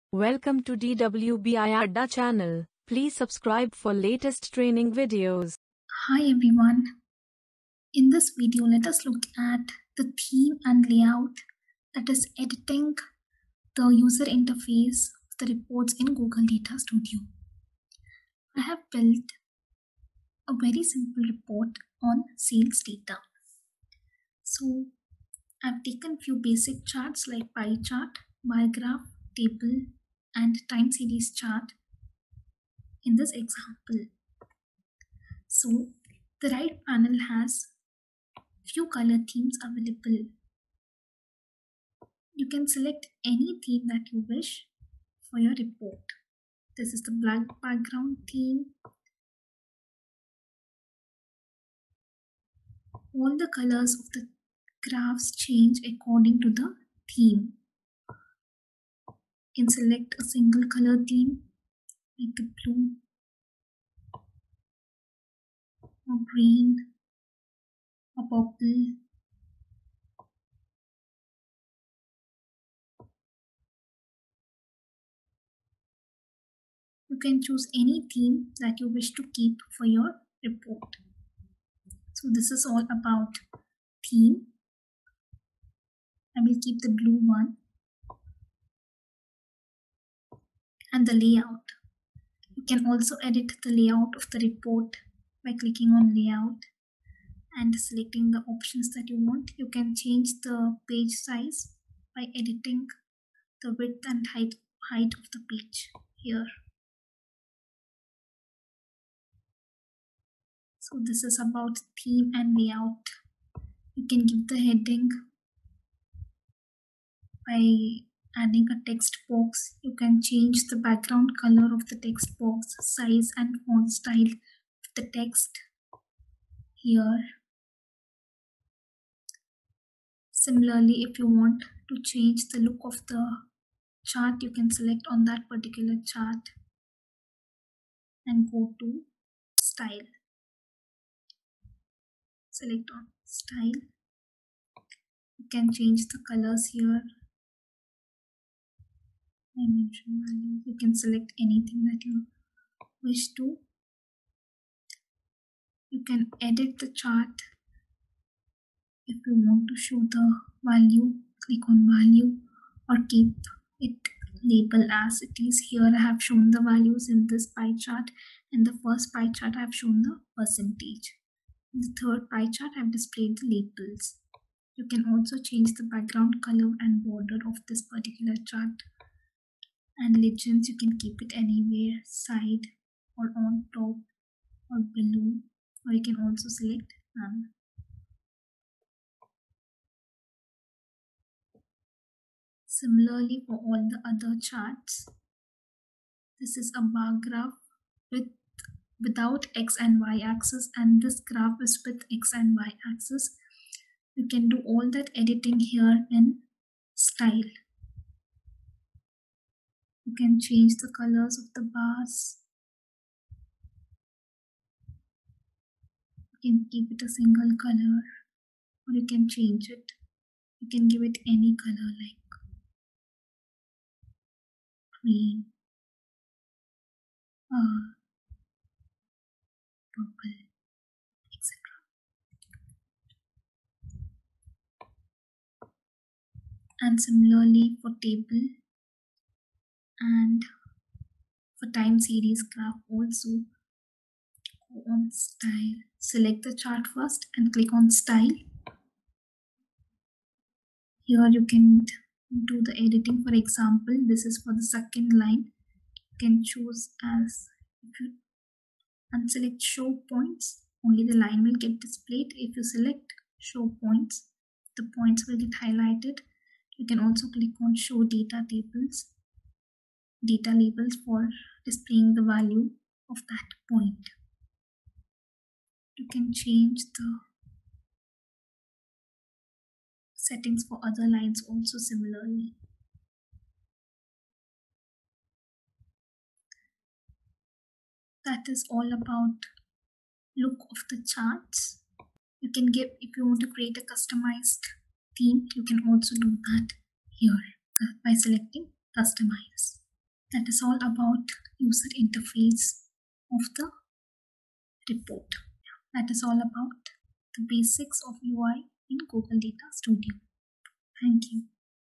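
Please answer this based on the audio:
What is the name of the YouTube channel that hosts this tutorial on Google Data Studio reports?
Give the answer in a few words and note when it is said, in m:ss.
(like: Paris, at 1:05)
DWBI Adda, at 0:00.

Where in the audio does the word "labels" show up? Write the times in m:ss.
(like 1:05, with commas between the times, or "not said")
2:44, 2:53, 4:30.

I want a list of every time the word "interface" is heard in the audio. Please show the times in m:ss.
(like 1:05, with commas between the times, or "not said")
0:14, 5:02.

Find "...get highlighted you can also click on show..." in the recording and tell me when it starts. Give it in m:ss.
4:25.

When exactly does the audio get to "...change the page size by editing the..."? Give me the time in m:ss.
1:39.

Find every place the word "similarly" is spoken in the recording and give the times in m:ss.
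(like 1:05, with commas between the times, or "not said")
2:10, 3:12, 3:56, 4:41.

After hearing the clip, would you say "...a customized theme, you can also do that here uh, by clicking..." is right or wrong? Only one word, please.
wrong.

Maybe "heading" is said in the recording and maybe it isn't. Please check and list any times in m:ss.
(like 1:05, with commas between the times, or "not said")
1:54.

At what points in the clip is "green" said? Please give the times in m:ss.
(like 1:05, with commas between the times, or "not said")
1:06, 3:45.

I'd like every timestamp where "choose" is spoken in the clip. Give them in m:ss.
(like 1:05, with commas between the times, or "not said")
1:17, 4:16.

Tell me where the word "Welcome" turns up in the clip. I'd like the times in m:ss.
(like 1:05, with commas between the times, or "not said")
0:00.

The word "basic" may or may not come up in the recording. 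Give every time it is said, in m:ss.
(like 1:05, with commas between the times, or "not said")
0:26, 5:07.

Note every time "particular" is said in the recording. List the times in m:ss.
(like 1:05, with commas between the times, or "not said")
2:15, 2:57.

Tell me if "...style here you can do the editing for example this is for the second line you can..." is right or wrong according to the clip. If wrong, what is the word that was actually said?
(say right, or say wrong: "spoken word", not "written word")
right.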